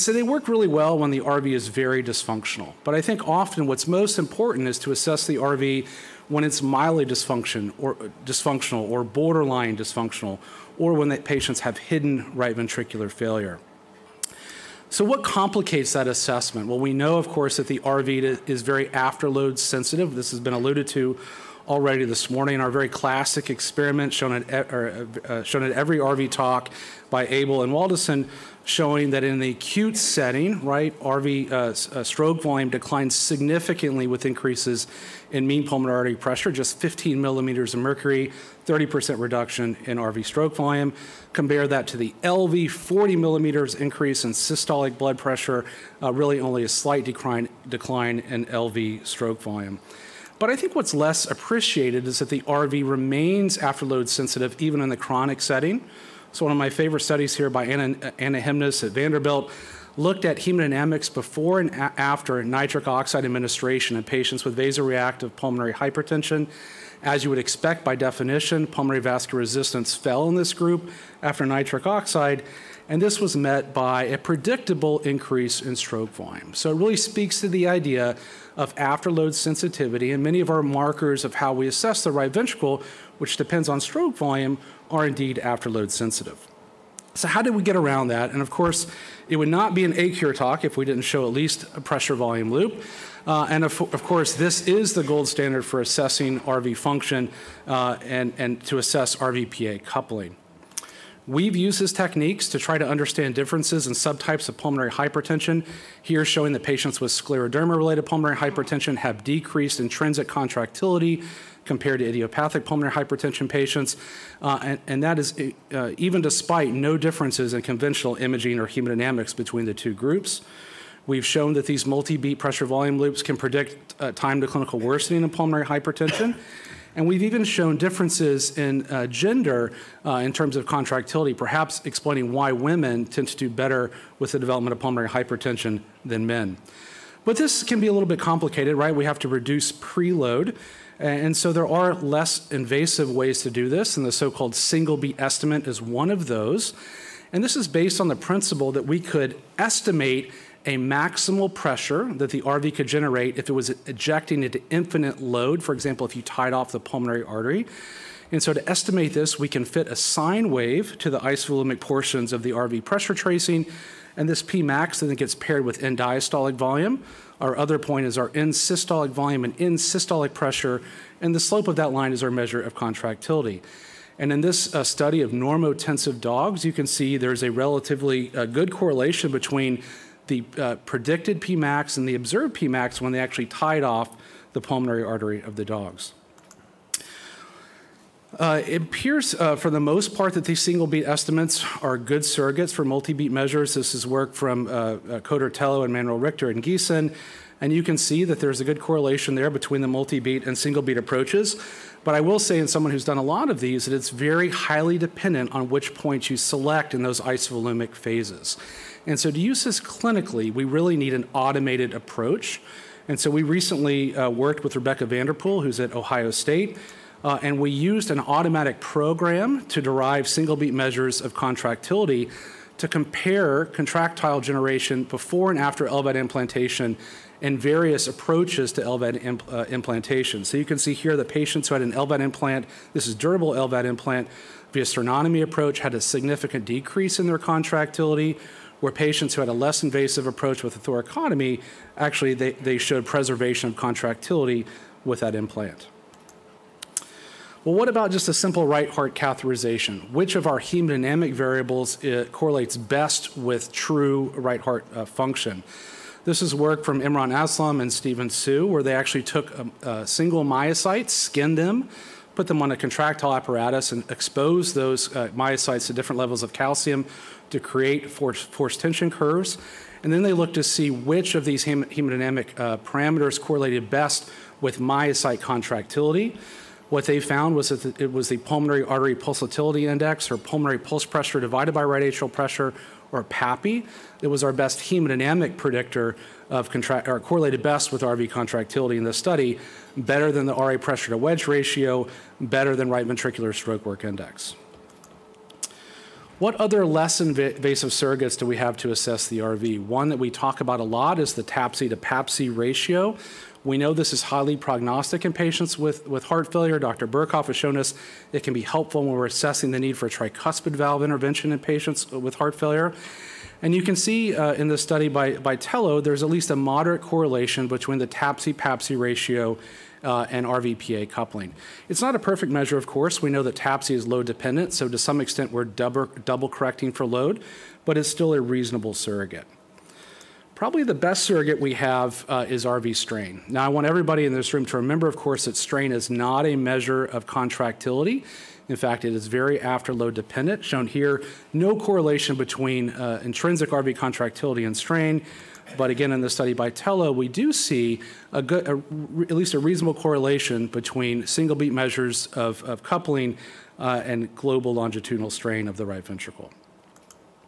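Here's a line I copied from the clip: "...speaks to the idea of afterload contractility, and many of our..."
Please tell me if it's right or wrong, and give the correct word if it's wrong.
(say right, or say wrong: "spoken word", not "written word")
wrong: "sensitivity", not "contractility".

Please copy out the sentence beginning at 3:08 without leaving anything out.
Uh, it appears, uh, for the most part, that these single beat estimates are good surrogates for multi beat measures.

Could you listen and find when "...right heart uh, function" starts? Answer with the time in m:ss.
4:14.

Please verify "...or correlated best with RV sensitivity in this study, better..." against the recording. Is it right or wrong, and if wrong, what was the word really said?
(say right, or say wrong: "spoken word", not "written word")
wrong: "contractility", not "sensitivity".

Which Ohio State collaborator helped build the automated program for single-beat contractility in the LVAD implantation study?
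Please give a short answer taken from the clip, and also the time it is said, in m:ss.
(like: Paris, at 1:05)
Rebecca Vanderpool, at 3:34.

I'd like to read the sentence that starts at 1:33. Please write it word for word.
Uh, and of, of, course, this is the gold standard for assessing RV function uh, and, and to assess RVPA coupling.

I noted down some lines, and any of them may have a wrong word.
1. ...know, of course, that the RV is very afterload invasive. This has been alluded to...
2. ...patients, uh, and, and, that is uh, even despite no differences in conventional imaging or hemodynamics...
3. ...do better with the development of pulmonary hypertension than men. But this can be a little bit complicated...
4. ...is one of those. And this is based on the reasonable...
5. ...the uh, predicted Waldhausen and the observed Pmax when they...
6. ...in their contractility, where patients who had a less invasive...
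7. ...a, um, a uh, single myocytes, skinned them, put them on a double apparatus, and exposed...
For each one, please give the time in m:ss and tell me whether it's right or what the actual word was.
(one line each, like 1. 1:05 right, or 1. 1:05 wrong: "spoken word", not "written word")
1. 0:16 wrong: "sensitive", not "invasive"
2. 1:53 right
3. 2:13 right
4. 2:25 wrong: "principle", not "reasonable"
5. 3:00 wrong: "Pmax", not "Waldhausen"
6. 3:57 right
7. 4:19 wrong: "contractile", not "double".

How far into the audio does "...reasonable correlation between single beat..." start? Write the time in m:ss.
5:49.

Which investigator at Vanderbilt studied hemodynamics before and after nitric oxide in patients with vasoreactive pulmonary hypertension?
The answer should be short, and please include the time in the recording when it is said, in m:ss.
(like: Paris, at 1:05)
Anna Hemnes, at 0:58.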